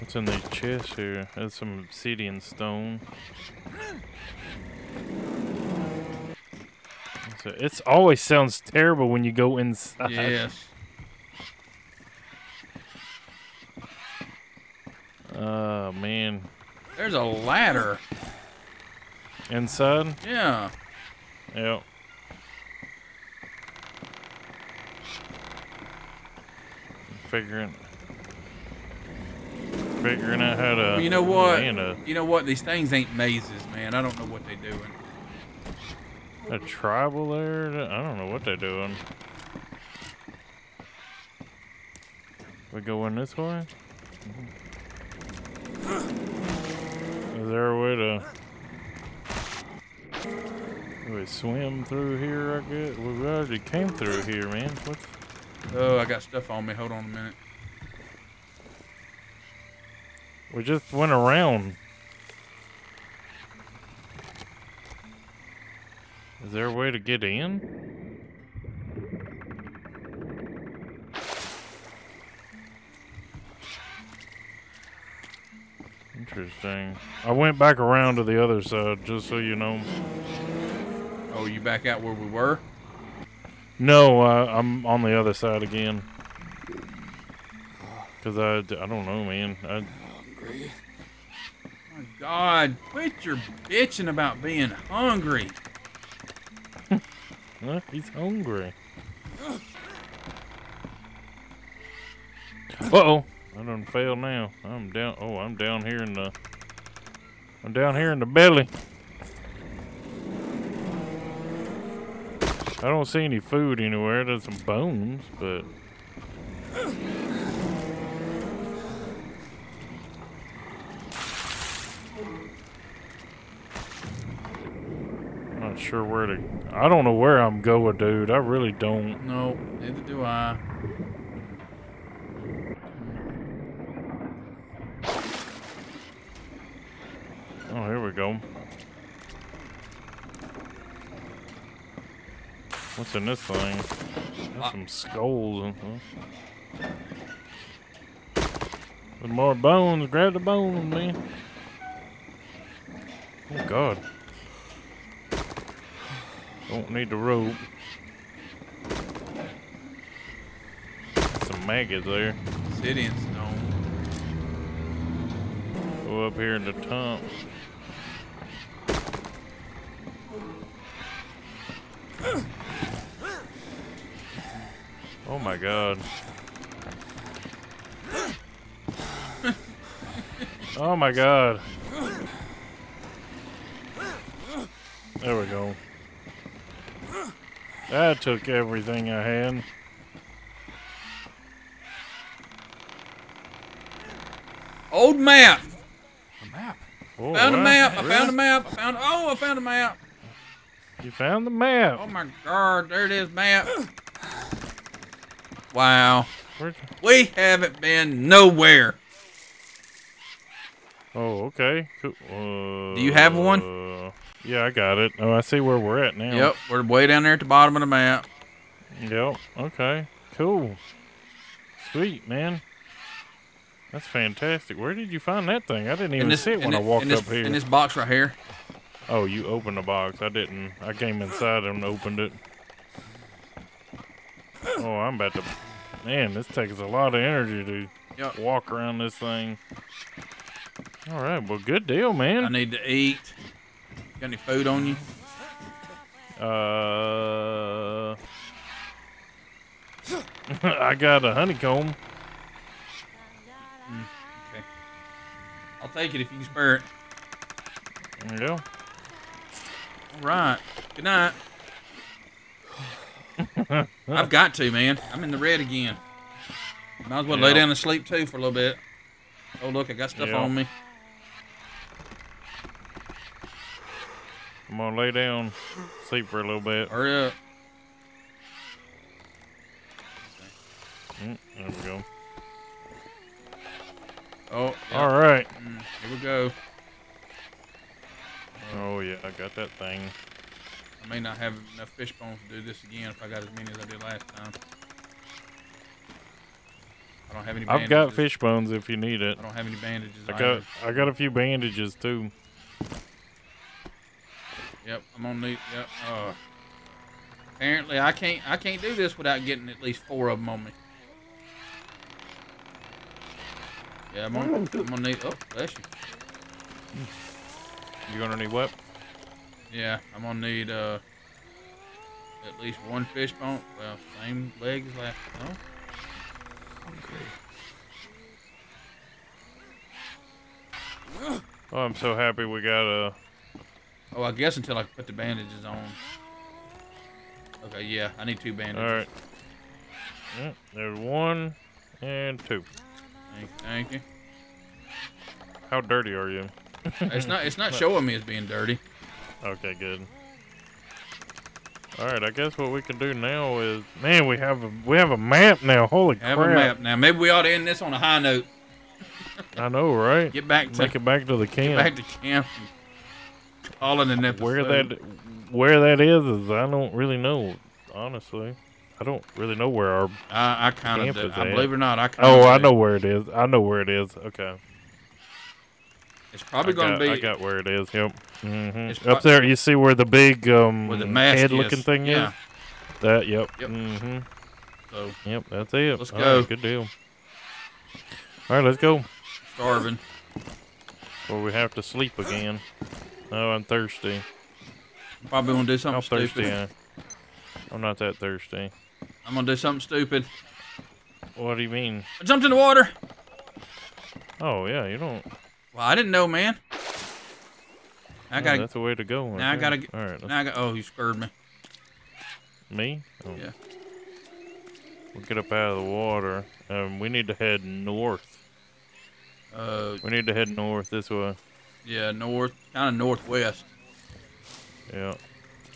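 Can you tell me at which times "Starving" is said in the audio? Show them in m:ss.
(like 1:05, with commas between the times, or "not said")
6:29.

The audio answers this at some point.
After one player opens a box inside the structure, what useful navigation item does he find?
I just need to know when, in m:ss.
3:14.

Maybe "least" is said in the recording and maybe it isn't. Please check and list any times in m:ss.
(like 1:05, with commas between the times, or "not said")
5:09, 5:22.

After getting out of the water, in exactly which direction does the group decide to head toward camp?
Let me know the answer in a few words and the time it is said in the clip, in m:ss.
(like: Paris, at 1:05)
Northwest, at 7:02.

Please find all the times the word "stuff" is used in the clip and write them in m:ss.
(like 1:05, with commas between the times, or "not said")
0:56, 4:30.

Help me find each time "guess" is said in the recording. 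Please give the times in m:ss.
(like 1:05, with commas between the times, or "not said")
0:52, 5:34, 5:52.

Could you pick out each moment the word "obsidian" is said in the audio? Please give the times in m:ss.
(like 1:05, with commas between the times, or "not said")
0:01, 2:42.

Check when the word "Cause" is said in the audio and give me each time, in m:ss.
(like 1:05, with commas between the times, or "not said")
1:28.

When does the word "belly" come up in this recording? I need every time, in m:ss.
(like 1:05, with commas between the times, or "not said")
1:48.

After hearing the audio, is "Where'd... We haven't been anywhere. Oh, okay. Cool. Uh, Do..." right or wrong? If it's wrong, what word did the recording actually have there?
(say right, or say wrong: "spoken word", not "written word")
wrong: "nowhere", not "anywhere".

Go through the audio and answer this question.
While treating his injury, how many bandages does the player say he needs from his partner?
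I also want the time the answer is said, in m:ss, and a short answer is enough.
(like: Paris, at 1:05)
2, at 5:37.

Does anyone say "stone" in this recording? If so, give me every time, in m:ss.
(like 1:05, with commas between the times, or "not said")
0:02, 2:43.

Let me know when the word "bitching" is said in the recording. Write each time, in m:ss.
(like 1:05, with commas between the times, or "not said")
1:33.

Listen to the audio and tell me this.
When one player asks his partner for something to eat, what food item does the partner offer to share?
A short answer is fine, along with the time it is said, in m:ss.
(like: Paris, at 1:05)
A honeycomb, at 4:10.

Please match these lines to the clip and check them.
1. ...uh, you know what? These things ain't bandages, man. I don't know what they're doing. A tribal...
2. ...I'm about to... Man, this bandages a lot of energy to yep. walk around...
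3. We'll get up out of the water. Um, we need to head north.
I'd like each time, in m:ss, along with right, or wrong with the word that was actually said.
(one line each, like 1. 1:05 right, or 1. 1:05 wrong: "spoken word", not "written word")
1. 0:31 wrong: "mazes", not "bandages"
2. 3:54 wrong: "takes", not "bandages"
3. 6:55 right.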